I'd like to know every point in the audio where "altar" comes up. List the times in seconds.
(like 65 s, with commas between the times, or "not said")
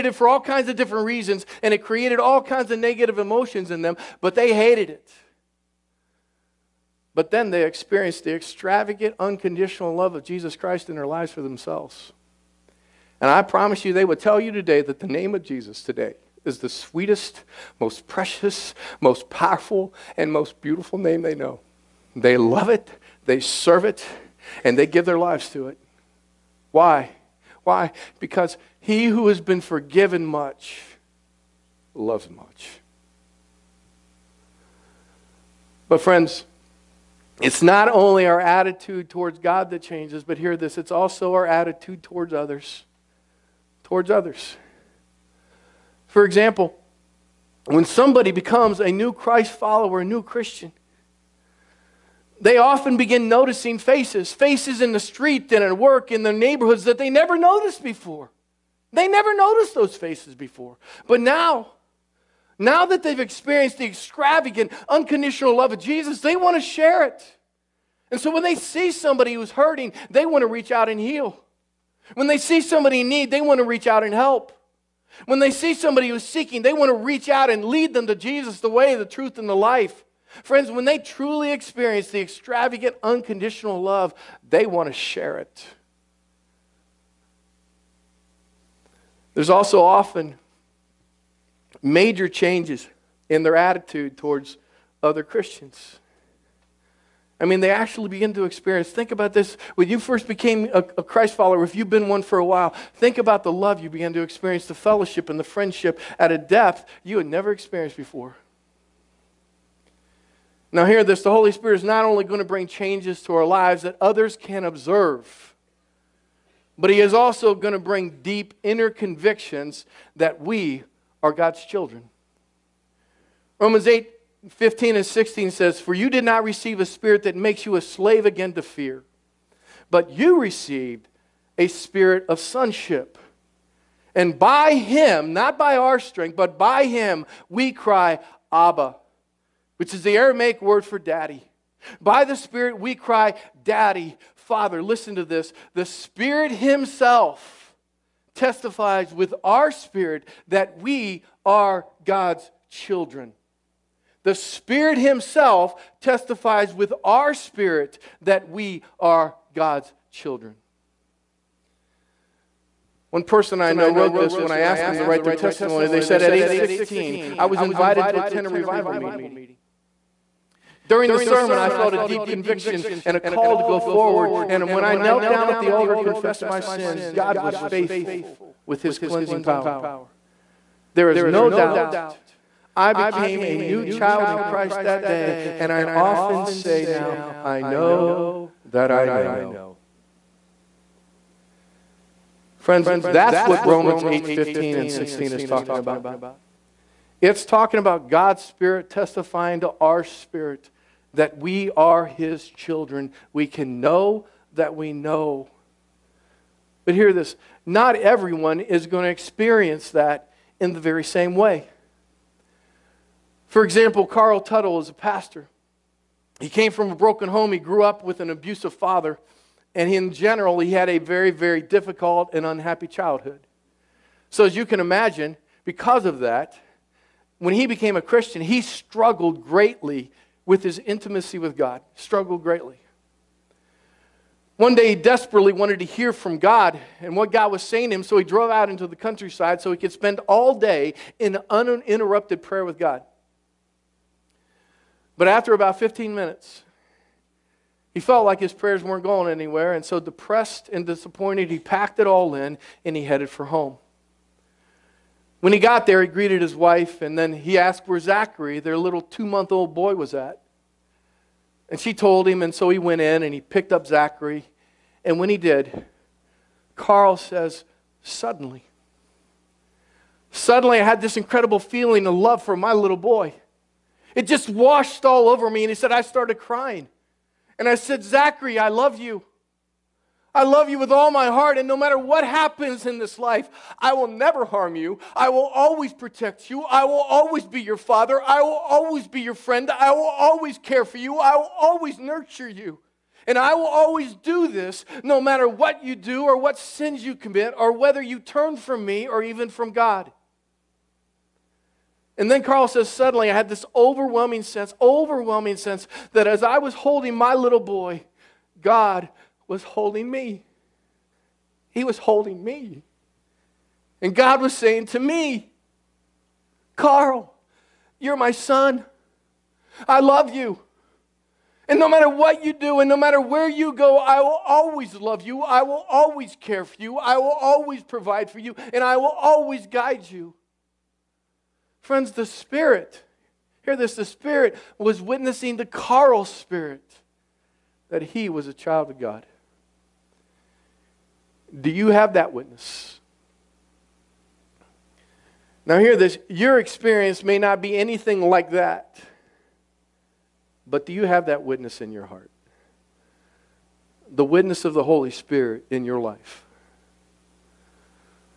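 175 s.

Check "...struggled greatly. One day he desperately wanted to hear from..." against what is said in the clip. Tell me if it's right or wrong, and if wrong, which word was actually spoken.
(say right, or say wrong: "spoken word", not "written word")
right.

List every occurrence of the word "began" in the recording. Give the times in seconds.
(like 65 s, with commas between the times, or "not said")
103 s.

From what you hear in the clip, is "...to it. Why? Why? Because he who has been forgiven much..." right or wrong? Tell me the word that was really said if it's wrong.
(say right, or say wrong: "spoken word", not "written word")
right.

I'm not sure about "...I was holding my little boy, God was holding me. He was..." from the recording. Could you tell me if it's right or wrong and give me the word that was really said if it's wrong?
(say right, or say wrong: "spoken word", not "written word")
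right.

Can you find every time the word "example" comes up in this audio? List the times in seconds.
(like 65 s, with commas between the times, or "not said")
46 s, 213 s.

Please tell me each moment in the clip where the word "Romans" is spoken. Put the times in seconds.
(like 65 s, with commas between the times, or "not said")
123 s, 193 s.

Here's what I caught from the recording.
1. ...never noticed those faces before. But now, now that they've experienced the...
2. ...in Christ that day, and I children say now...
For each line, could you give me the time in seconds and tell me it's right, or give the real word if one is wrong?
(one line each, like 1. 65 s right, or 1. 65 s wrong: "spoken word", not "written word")
1. 59 s right
2. 184 s wrong: "often", not "children".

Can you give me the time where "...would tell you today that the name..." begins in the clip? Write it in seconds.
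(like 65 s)
14 s.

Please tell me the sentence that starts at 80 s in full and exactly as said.
Friends, when they truly experience the extravagant, unconditional love, they want to share it.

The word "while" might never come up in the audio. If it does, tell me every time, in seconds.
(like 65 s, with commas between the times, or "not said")
102 s.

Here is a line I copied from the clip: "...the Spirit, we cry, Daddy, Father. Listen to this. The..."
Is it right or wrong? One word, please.
right.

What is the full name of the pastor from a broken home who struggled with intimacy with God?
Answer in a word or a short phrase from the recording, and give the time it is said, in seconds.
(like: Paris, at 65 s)
Carl Tuttle, at 214 s.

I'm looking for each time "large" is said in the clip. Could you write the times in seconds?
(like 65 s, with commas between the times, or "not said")
not said.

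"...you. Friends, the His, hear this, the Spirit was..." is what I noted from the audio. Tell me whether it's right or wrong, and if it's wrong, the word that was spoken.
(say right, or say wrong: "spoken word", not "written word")
wrong: "Spirit", not "His".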